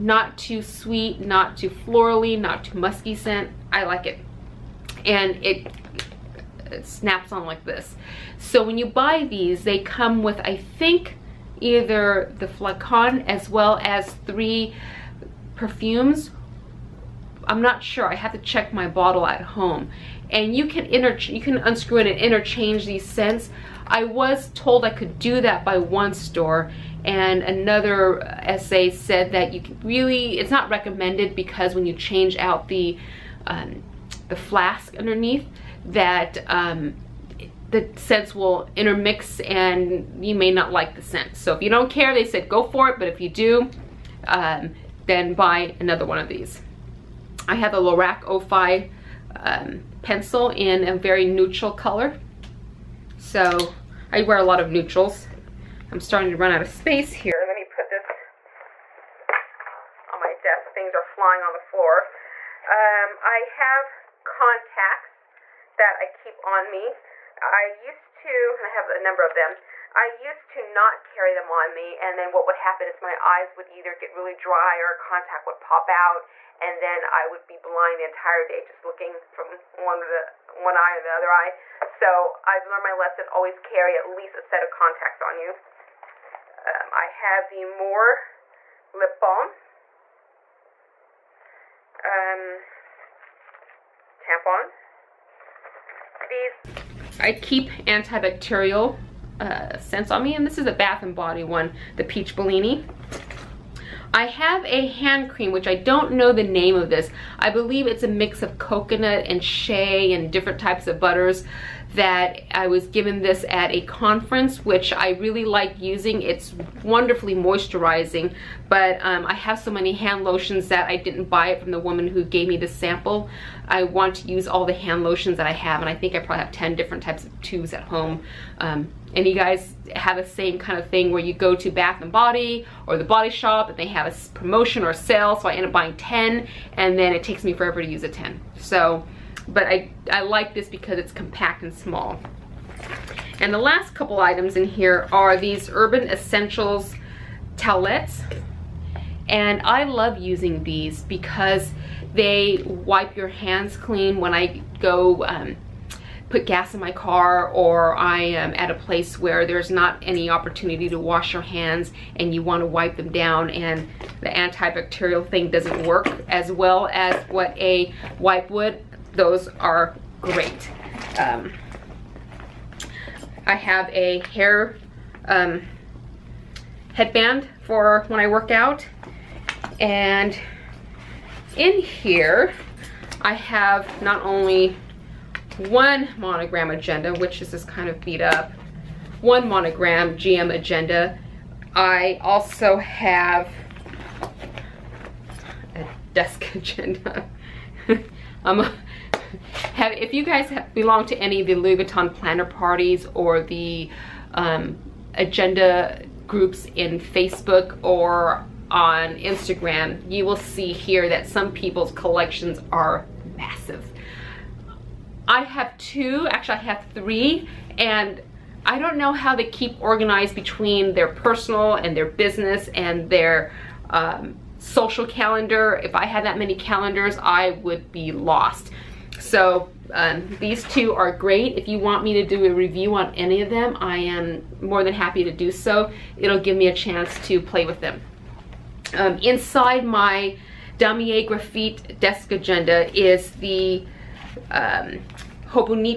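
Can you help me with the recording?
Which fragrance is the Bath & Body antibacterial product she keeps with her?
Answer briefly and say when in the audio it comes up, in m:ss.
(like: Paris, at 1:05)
Peach Bellini, at 1:42.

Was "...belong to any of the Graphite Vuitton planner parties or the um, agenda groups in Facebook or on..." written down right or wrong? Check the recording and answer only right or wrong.
wrong.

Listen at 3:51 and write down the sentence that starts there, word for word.
If you want me to do a review on any of them, I am more than happy to do so.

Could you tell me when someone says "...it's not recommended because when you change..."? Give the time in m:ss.
0:30.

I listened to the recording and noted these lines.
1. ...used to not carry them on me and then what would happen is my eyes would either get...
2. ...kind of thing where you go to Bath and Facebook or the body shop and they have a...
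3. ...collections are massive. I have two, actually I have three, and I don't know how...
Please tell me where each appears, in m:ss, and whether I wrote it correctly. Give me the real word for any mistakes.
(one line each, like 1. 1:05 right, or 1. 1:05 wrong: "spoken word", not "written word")
1. 1:10 right
2. 2:10 wrong: "Body", not "Facebook"
3. 3:31 right.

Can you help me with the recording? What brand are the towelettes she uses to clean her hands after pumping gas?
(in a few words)
Urban Essentials.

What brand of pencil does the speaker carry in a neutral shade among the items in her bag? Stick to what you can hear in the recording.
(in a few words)
Lorac.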